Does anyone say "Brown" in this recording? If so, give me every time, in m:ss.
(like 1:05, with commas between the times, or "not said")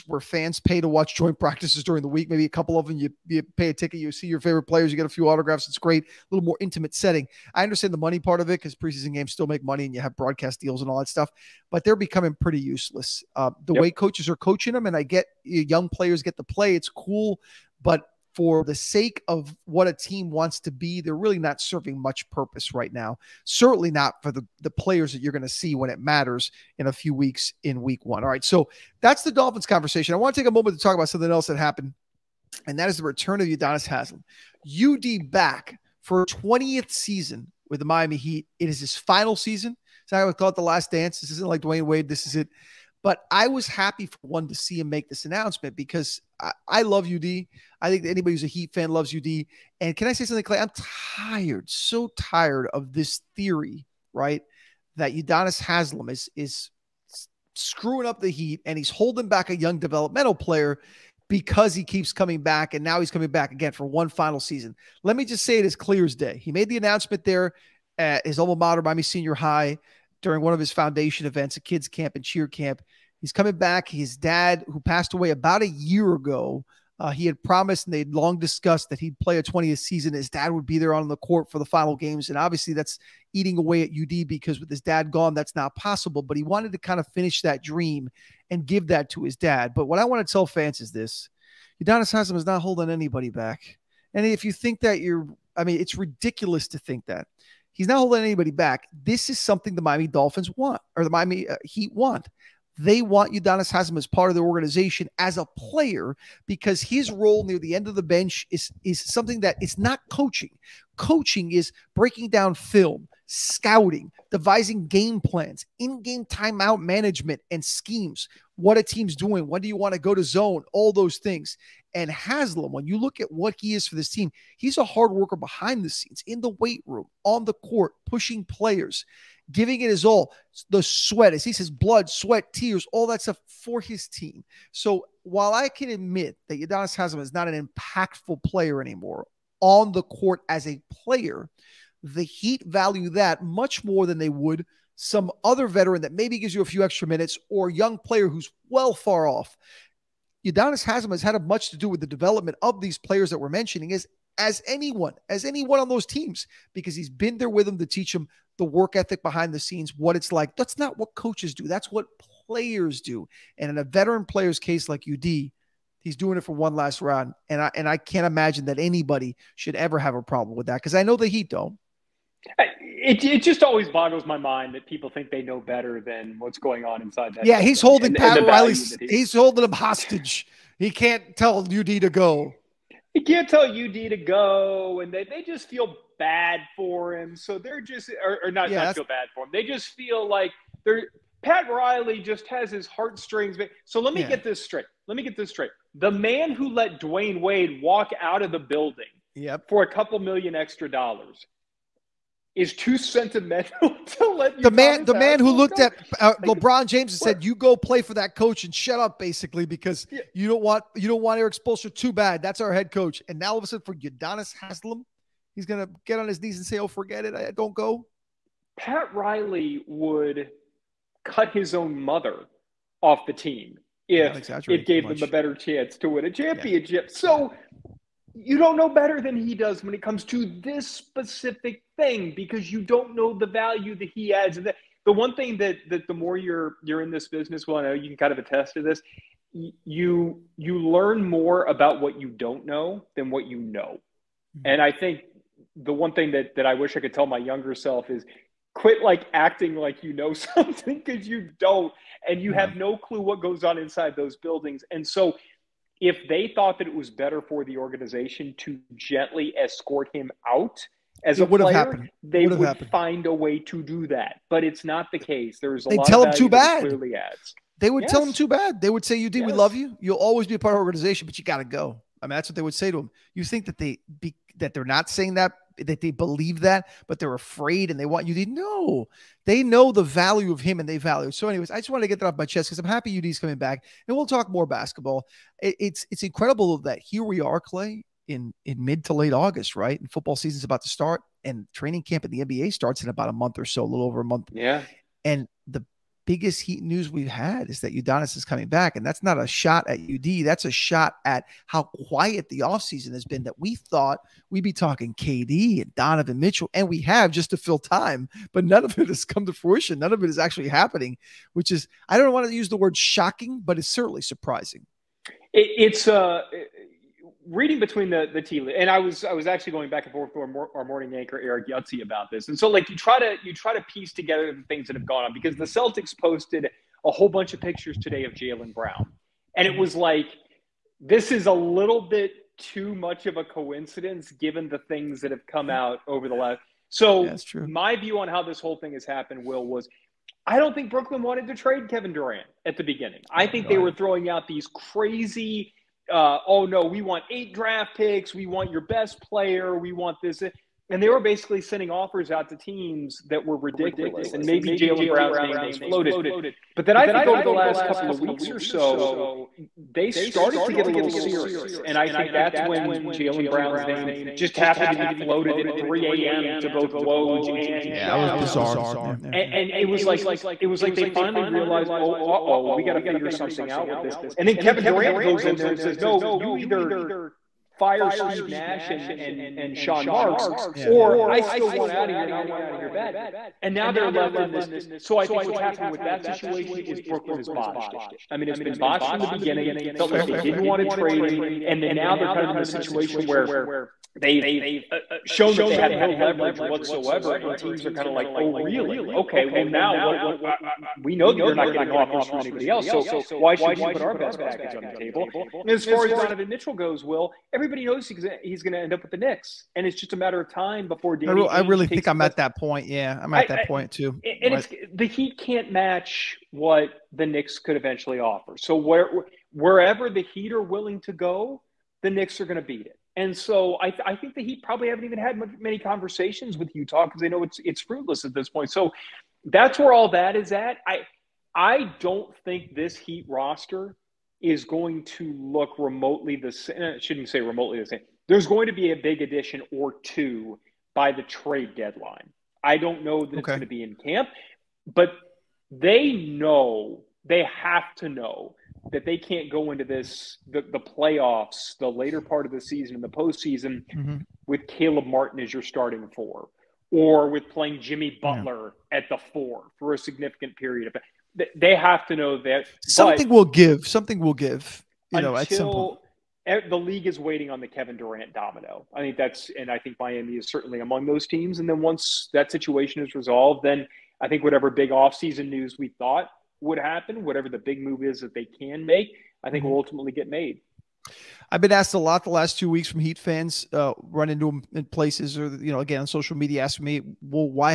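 5:28, 5:55, 6:03.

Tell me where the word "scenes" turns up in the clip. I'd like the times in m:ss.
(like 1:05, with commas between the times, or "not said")
2:05, 2:39.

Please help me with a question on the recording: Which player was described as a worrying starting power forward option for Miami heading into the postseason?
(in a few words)
Caleb Martin.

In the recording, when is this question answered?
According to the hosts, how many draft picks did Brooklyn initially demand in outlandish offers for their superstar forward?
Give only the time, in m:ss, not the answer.
5:47.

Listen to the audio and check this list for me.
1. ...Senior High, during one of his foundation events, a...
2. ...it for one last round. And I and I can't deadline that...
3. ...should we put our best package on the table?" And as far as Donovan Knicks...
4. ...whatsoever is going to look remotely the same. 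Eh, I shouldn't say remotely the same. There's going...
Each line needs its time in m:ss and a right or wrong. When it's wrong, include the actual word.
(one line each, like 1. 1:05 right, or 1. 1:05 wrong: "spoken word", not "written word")
1. 1:09 right
2. 2:46 wrong: "imagine", not "deadline"
3. 6:43 wrong: "Mitchell", not "Knicks"
4. 7:13 wrong: "roster", not "whatsoever".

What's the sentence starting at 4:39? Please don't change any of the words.
They know the value of him and they value.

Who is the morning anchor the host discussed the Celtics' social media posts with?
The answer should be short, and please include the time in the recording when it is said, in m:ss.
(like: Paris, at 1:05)
Eric Yutzi, at 5:21.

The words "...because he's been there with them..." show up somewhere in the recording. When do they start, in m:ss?
2:36.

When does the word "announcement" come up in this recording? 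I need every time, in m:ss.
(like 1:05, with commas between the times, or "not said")
0:45, 1:06.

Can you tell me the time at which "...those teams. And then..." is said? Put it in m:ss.
7:51.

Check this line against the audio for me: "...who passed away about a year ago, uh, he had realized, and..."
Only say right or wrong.
wrong.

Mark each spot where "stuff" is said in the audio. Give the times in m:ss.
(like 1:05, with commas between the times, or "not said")
0:11, 2:13.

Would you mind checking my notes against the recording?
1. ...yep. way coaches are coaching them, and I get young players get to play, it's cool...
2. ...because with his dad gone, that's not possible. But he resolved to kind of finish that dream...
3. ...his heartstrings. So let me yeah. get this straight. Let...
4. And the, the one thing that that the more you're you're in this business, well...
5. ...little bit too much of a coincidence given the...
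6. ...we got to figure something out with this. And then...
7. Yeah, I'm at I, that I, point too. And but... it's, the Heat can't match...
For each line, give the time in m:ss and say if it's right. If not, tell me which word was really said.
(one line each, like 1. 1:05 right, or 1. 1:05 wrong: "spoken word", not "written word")
1. 0:13 right
2. 1:24 wrong: "wanted", not "resolved"
3. 3:12 right
4. 3:54 right
5. 5:31 right
6. 6:12 right
7. 6:52 right.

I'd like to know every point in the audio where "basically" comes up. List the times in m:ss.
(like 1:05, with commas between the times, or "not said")
3:29, 5:51.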